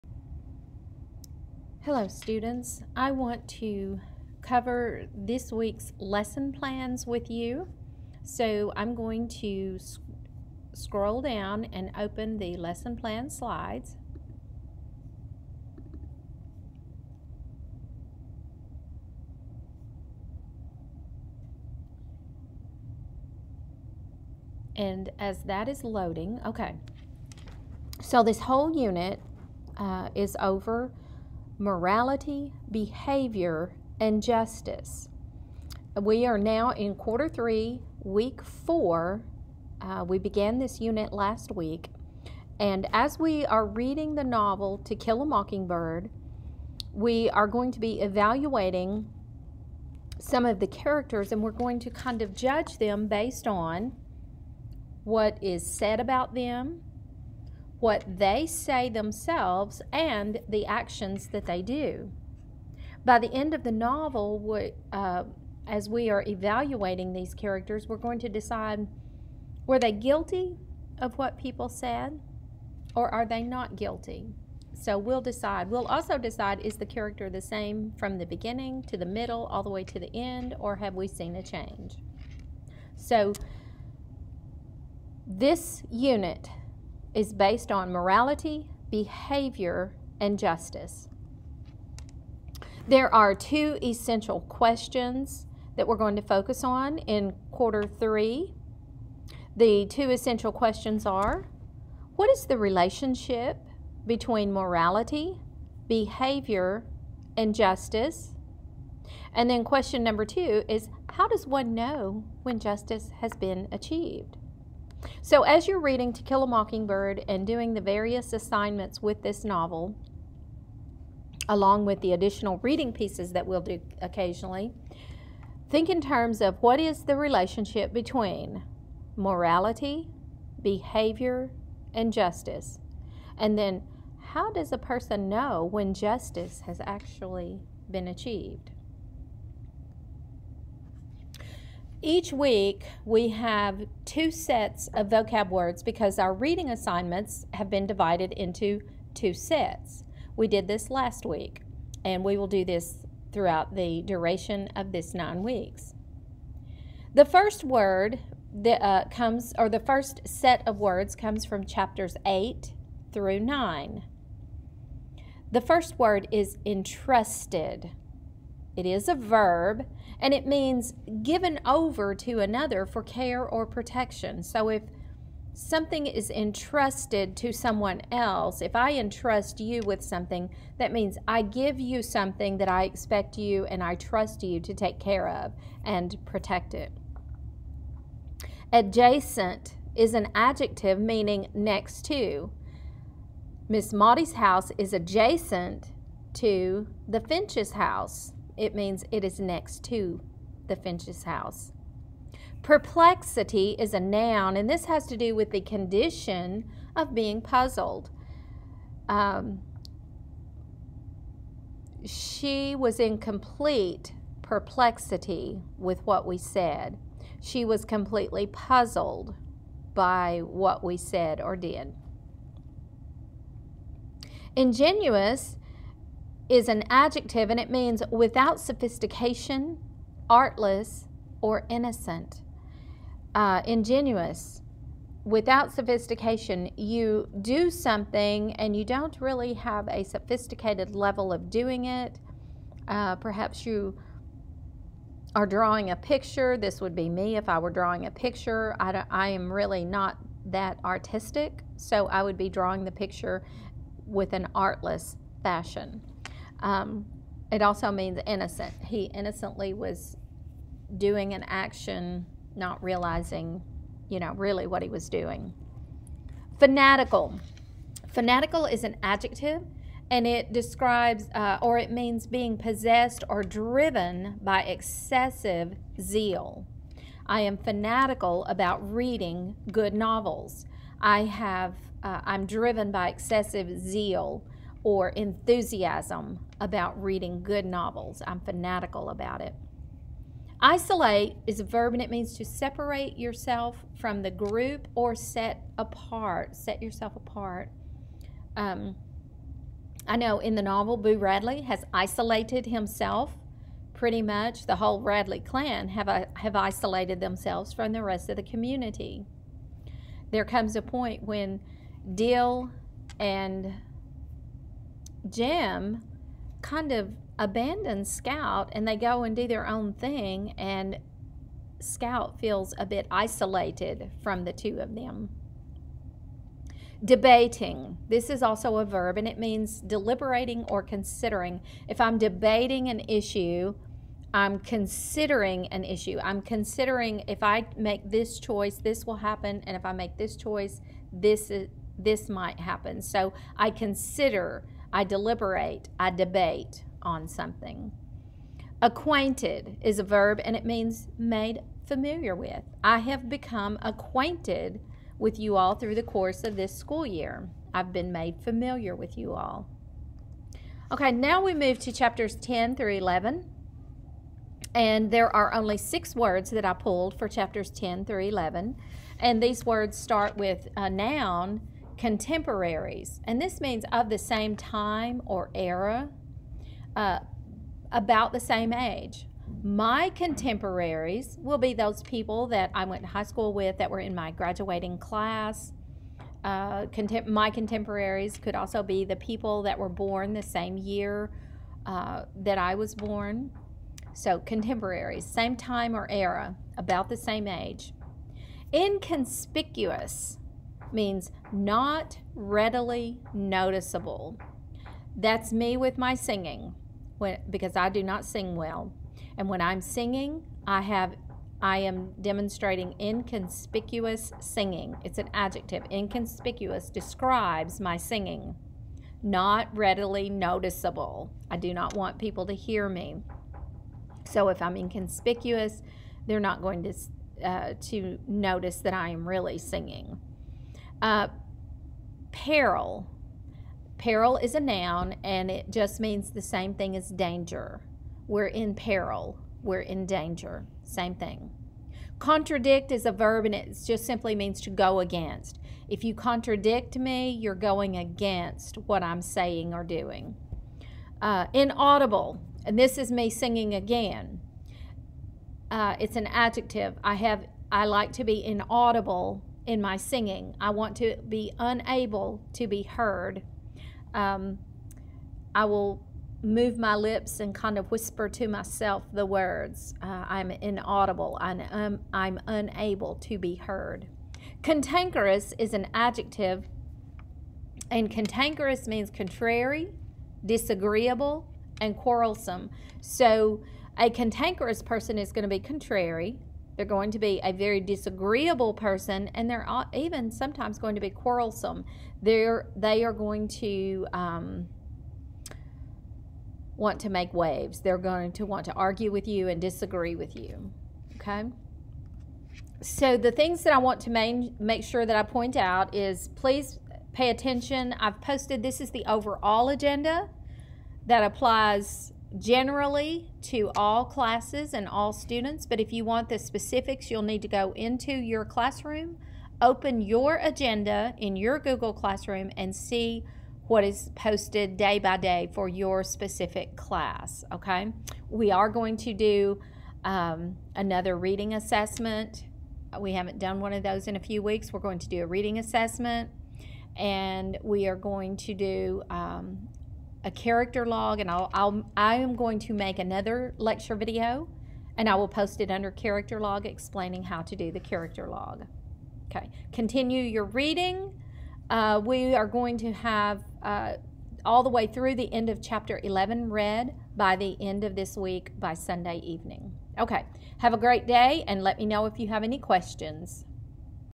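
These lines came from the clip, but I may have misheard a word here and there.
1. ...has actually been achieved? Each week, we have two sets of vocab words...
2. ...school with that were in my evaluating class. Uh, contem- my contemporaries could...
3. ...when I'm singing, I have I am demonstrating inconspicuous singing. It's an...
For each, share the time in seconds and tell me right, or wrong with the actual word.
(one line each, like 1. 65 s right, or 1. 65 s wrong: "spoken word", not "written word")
1. 136 s right
2. 383 s wrong: "graduating", not "evaluating"
3. 409 s right.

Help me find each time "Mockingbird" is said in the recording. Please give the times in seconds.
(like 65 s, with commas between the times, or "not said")
45 s, 116 s.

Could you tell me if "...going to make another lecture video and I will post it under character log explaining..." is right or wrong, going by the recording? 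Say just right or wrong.
right.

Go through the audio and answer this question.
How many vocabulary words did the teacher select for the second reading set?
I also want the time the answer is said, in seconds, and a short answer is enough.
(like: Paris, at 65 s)
6, at 365 s.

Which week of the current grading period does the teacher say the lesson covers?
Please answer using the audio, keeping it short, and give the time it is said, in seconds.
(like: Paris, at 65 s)
week four, at 38 s.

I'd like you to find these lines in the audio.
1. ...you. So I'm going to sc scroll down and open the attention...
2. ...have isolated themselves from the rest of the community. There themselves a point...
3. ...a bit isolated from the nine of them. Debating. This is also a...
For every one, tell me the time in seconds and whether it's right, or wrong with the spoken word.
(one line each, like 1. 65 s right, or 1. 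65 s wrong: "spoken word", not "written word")
1. 7 s wrong: "lesson", not "attention"
2. 306 s wrong: "comes", not "themselves"
3. 322 s wrong: "two", not "nine".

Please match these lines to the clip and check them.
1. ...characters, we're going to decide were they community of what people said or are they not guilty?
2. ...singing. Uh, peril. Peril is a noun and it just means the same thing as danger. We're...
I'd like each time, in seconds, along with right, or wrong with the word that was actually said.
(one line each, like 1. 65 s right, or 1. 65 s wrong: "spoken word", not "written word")
1. 67 s wrong: "guilty", not "community"
2. 429 s right.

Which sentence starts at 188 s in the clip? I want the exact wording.
Adjacent is an adjective meaning next to.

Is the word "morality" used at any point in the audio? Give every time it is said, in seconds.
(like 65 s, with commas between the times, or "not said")
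31 s, 87 s, 104 s, 129 s.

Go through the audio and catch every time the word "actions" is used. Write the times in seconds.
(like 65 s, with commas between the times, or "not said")
60 s, 261 s.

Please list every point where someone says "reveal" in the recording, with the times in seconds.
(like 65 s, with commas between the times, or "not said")
not said.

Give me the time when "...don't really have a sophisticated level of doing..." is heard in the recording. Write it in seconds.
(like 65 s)
238 s.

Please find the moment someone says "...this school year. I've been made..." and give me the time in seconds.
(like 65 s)
356 s.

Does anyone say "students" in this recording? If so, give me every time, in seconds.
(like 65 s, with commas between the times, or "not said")
2 s, 515 s.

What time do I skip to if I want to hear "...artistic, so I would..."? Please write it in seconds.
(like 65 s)
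250 s.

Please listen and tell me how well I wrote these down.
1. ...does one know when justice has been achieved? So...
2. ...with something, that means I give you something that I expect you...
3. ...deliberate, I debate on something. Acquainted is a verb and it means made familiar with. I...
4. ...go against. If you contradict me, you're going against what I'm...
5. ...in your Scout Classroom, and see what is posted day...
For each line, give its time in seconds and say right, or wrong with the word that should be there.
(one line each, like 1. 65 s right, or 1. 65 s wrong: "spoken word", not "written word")
1. 111 s right
2. 179 s right
3. 345 s right
4. 444 s right
5. 521 s wrong: "Google", not "Scout".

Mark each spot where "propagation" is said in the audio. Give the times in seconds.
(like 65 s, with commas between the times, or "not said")
not said.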